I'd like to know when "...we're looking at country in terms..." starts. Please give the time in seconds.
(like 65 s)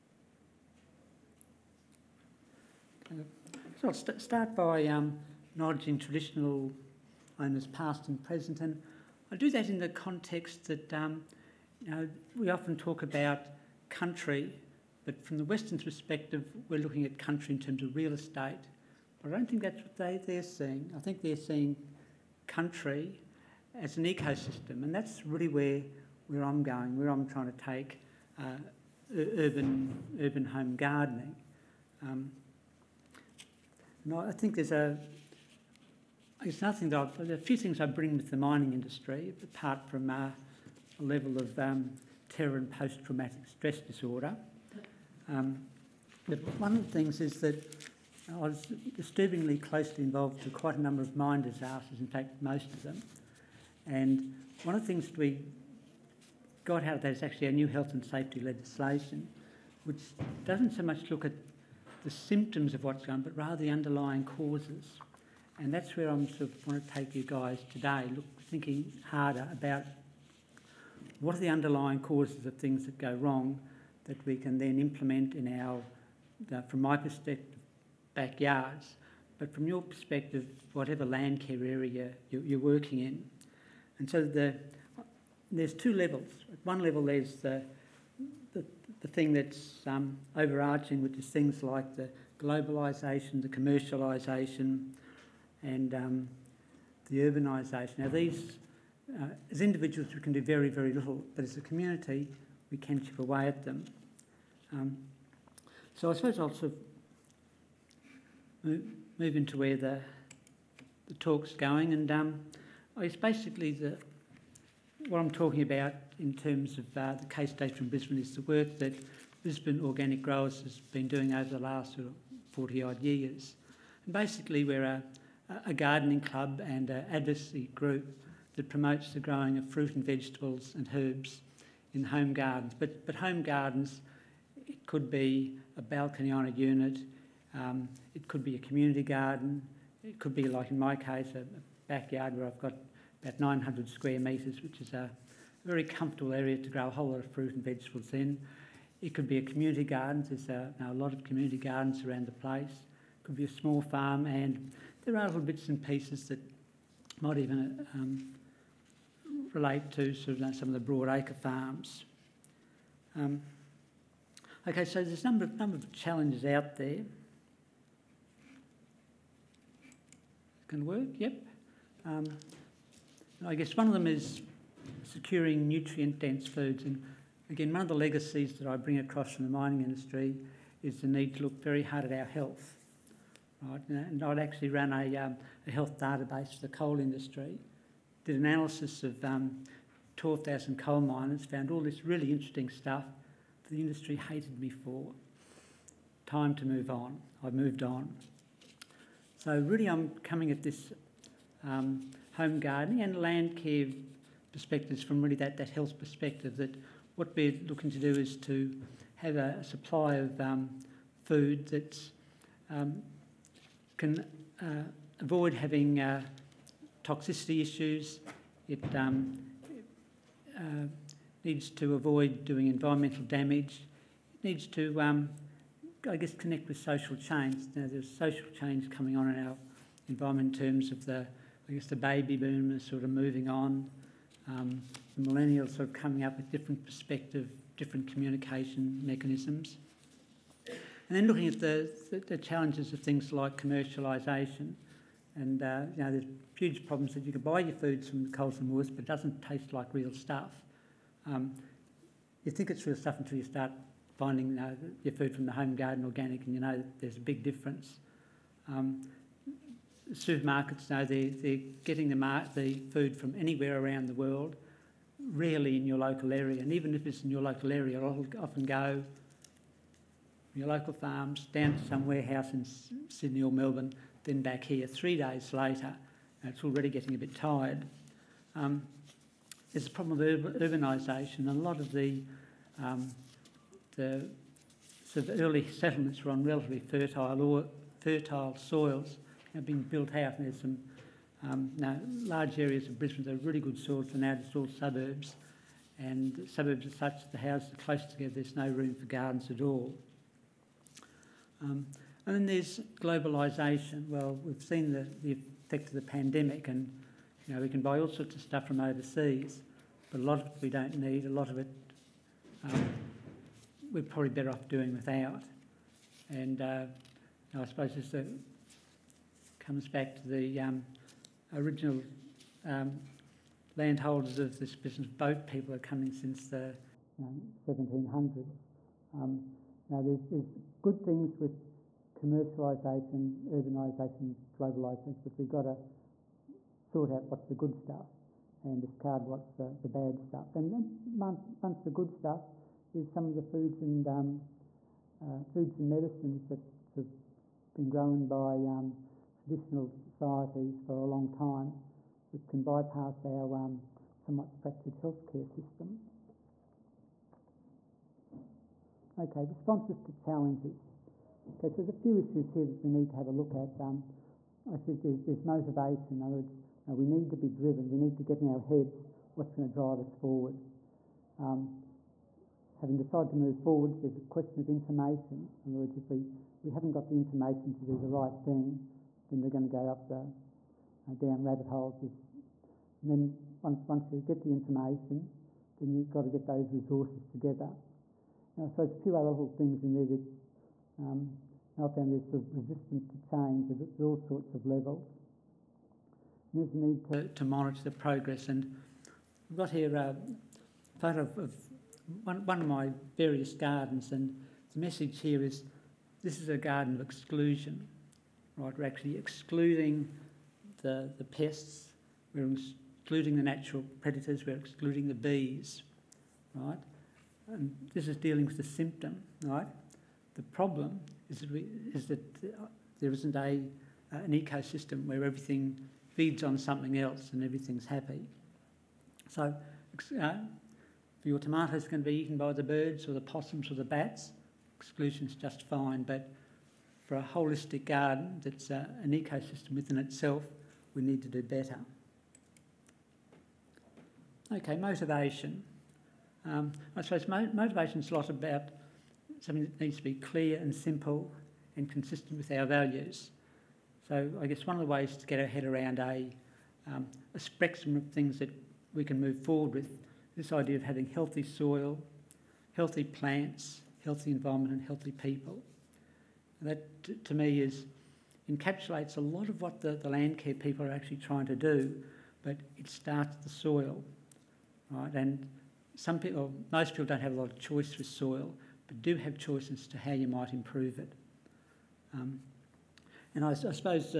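16 s.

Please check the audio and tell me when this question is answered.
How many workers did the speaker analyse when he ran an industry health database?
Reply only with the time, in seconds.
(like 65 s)
190 s.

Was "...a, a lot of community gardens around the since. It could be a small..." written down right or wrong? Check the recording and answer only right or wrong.
wrong.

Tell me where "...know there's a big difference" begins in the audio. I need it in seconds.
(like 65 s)
256 s.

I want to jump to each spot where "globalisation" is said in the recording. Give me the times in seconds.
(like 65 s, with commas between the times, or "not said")
92 s, 302 s, 334 s.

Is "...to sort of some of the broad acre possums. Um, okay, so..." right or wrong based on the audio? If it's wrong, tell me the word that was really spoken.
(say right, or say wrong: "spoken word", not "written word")
wrong: "farms", not "possums".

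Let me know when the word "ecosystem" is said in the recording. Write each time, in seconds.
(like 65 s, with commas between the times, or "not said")
24 s, 424 s, 439 s.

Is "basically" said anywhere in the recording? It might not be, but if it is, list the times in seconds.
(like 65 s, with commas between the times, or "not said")
113 s, 124 s.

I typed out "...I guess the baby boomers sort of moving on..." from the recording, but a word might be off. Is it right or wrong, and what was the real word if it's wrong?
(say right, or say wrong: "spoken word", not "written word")
right.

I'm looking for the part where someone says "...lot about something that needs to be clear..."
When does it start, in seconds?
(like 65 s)
448 s.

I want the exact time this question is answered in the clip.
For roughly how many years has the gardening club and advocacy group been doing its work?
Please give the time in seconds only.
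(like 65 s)
122 s.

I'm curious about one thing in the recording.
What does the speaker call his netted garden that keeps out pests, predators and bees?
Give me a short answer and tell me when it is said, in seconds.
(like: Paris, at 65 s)
Garden of exclusion, at 406 s.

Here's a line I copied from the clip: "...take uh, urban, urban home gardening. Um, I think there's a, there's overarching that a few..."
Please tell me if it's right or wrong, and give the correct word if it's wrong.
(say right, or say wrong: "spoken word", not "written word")
wrong: "nothing", not "overarching".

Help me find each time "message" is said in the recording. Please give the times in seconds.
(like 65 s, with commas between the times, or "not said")
404 s.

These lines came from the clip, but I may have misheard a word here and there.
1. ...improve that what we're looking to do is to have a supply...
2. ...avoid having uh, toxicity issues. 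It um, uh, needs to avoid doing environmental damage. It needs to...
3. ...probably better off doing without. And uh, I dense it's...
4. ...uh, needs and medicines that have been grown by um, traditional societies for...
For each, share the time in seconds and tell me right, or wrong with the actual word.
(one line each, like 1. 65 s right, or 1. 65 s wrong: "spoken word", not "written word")
1. 205 s wrong: "perspective", not "improve"
2. 215 s right
3. 314 s wrong: "suppose", not "dense"
4. 345 s wrong: "foods", not "needs".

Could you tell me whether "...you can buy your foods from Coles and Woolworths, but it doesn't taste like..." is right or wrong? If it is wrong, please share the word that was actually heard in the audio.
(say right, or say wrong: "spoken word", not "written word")
right.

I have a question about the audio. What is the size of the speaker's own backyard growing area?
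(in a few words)
900 square metres.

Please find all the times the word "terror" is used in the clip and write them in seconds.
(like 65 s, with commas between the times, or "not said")
42 s.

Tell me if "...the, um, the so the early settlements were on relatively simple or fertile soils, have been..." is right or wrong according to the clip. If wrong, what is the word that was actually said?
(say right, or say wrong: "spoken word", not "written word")
wrong: "fertile", not "simple".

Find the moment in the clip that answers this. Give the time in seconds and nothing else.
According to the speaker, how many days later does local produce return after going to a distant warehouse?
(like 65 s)
274 s.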